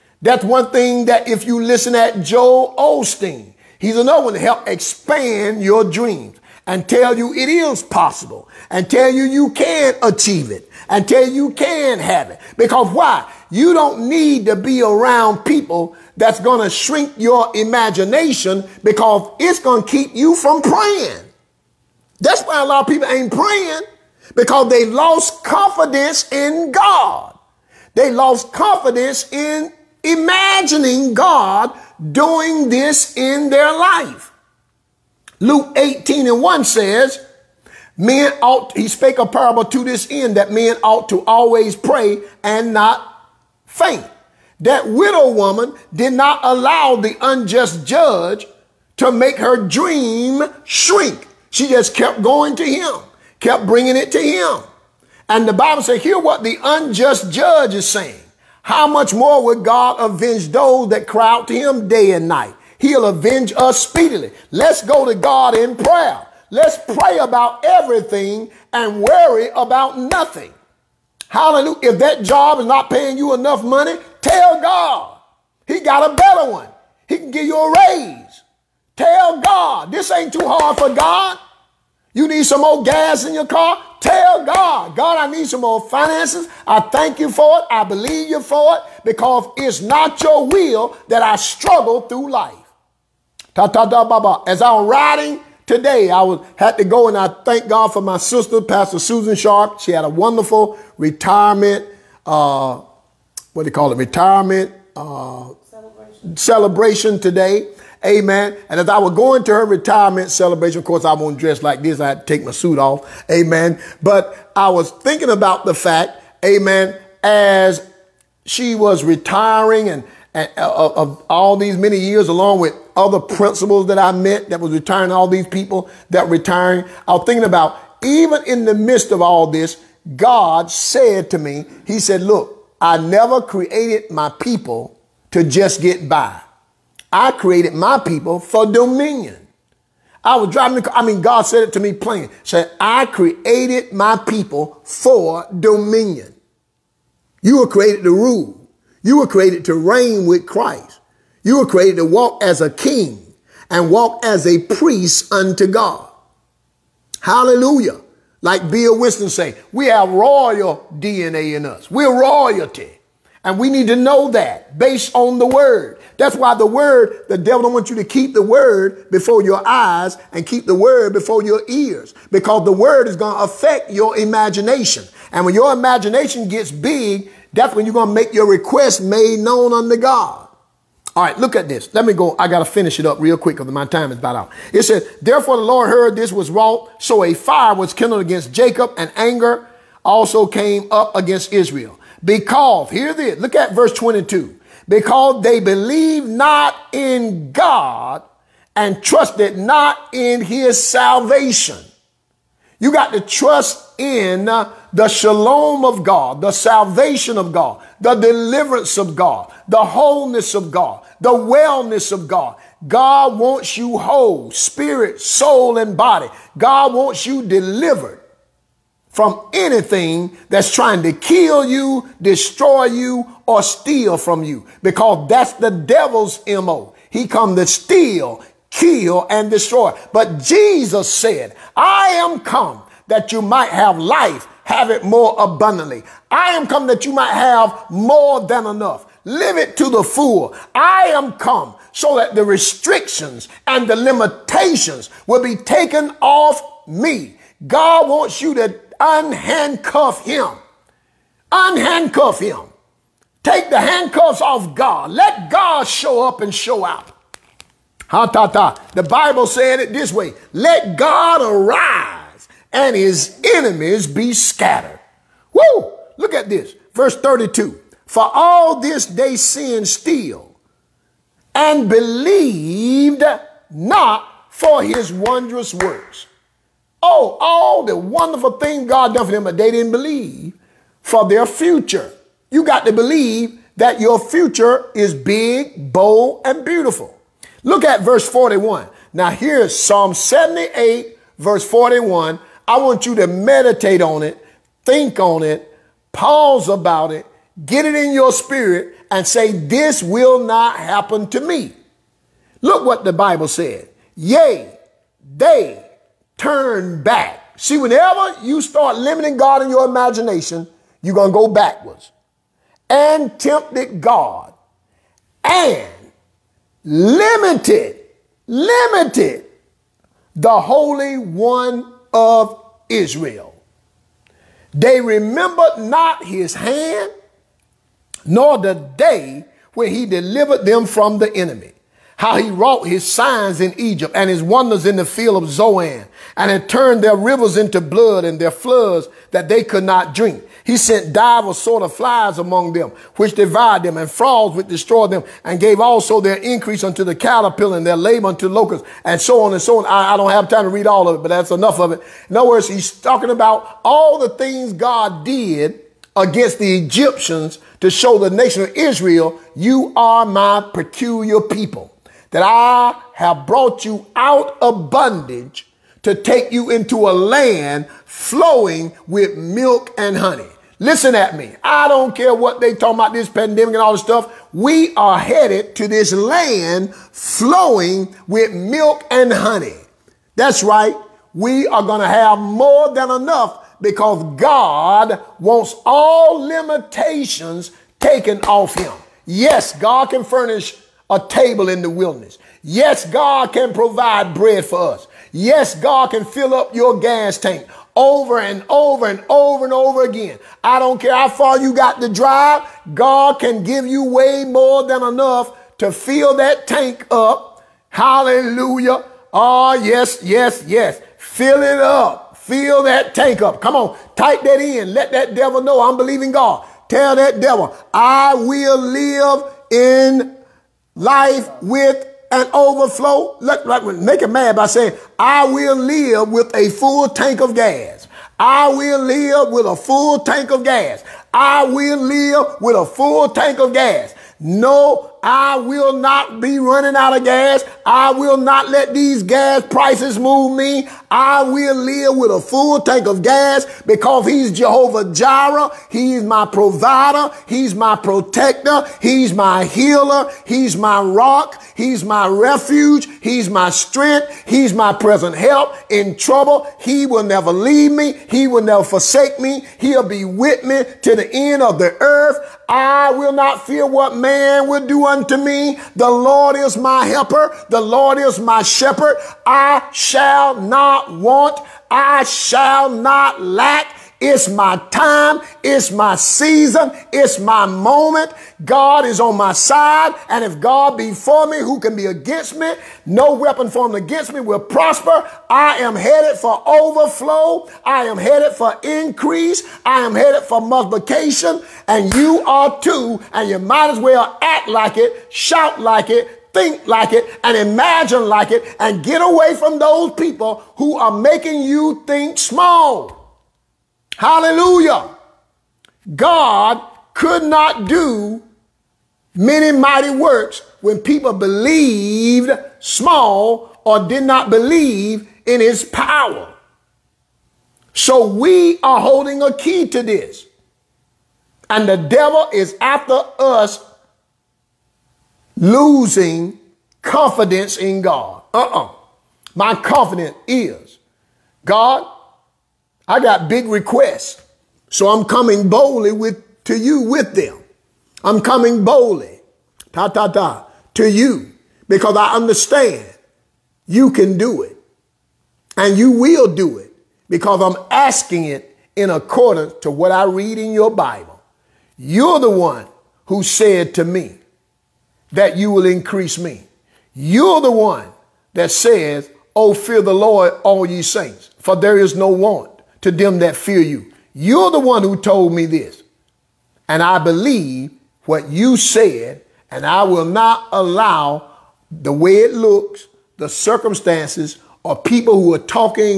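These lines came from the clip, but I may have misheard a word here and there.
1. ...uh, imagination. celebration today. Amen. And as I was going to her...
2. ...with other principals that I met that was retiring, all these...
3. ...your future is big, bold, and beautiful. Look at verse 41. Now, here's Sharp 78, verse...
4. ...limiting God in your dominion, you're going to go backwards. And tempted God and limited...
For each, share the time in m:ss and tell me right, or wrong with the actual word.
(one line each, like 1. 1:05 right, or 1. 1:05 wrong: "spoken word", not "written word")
1. 1:44 wrong: "celebration", not "imagination"
2. 2:02 right
3. 4:43 wrong: "Psalm", not "Sharp"
4. 5:08 wrong: "imagination", not "dominion".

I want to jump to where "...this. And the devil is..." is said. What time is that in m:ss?
8:40.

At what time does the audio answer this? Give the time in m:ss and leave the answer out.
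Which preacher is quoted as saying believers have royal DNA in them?
2:38.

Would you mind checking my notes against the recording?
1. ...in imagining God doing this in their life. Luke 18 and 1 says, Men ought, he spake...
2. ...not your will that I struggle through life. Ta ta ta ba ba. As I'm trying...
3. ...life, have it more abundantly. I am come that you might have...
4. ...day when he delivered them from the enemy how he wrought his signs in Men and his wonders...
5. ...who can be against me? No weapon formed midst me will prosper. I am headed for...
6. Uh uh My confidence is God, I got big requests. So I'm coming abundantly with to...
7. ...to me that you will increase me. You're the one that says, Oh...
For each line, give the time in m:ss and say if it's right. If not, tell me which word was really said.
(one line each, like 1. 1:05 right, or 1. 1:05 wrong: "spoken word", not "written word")
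1. 0:29 right
2. 1:29 wrong: "riding", not "trying"
3. 3:53 right
4. 5:28 wrong: "Egypt", not "Men"
5. 8:01 wrong: "against", not "midst"
6. 8:48 wrong: "boldly", not "abundantly"
7. 9:13 right.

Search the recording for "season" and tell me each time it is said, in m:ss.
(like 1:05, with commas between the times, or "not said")
7:56.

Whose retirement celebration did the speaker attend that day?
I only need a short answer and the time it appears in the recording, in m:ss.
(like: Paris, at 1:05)
Susan Sharp, at 1:38.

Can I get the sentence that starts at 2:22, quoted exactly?
Said, I created my people for dominion.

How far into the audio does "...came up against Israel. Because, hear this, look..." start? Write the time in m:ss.
3:10.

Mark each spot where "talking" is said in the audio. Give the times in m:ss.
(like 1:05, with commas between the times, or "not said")
5:52, 6:12, 9:35.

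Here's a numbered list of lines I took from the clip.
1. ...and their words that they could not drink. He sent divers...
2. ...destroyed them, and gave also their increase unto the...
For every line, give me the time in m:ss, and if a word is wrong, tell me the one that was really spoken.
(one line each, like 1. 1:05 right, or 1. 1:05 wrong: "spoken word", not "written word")
1. 5:38 wrong: "floods", not "words"
2. 5:44 right.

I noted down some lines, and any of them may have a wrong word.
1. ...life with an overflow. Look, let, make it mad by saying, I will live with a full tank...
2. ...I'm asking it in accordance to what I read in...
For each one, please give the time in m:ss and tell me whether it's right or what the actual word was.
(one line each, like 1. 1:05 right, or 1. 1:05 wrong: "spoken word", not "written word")
1. 7:00 right
2. 9:07 right.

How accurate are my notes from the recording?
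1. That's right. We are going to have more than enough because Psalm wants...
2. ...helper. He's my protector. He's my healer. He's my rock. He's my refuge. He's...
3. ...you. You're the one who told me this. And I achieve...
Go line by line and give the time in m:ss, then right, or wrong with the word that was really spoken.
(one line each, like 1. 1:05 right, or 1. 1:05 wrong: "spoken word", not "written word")
1. 6:20 wrong: "God", not "Psalm"
2. 7:26 wrong: "provider", not "helper"
3. 9:23 wrong: "believe", not "achieve".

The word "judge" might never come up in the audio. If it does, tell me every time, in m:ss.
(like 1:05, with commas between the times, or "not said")
0:47, 0:57.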